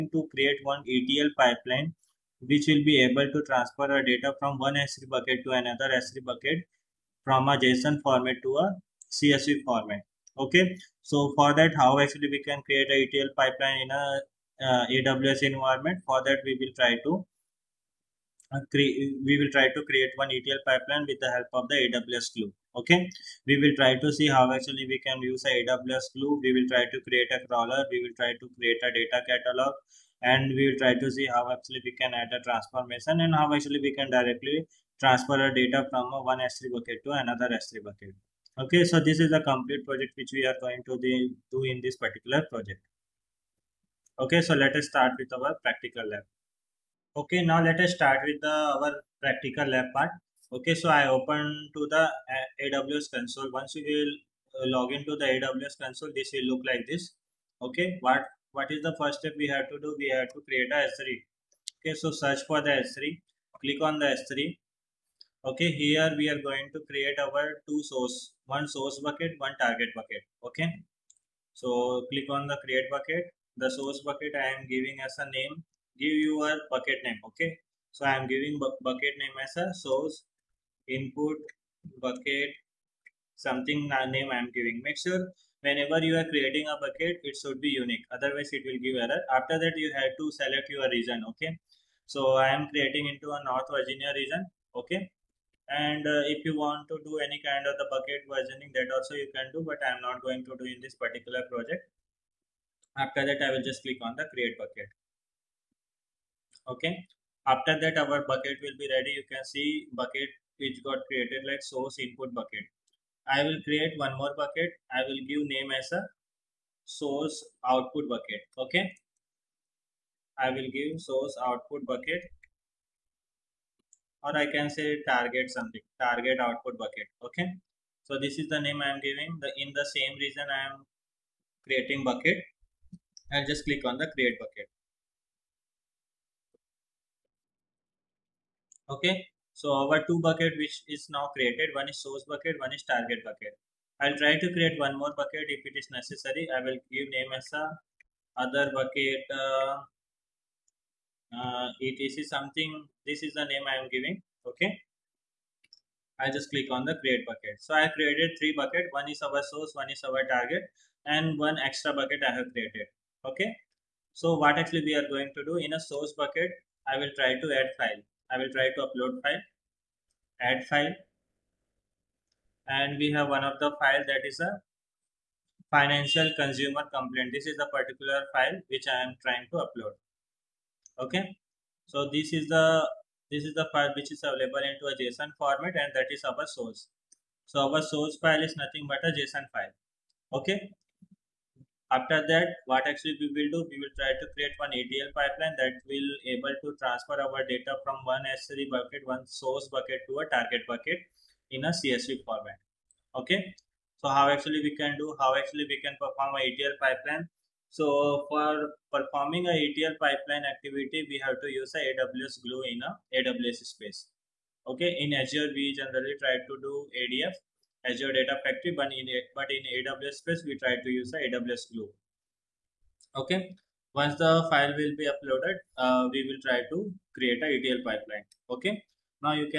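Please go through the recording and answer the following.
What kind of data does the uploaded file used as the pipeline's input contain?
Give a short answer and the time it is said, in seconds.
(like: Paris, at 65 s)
Financial consumer complaint, at 175 s.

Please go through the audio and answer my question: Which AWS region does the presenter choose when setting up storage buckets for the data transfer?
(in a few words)
North Virginia.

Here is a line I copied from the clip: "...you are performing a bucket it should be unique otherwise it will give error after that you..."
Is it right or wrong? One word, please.
wrong.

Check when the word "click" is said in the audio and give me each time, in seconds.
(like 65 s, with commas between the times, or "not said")
63 s, 72 s, 103 s, 133 s, 156 s.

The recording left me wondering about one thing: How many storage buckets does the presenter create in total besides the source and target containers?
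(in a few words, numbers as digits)
3.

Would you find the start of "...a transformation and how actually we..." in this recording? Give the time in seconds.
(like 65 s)
32 s.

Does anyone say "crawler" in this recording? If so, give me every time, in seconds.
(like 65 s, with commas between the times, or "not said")
27 s.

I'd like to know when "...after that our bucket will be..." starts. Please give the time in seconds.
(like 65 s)
107 s.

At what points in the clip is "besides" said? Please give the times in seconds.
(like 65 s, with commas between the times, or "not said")
not said.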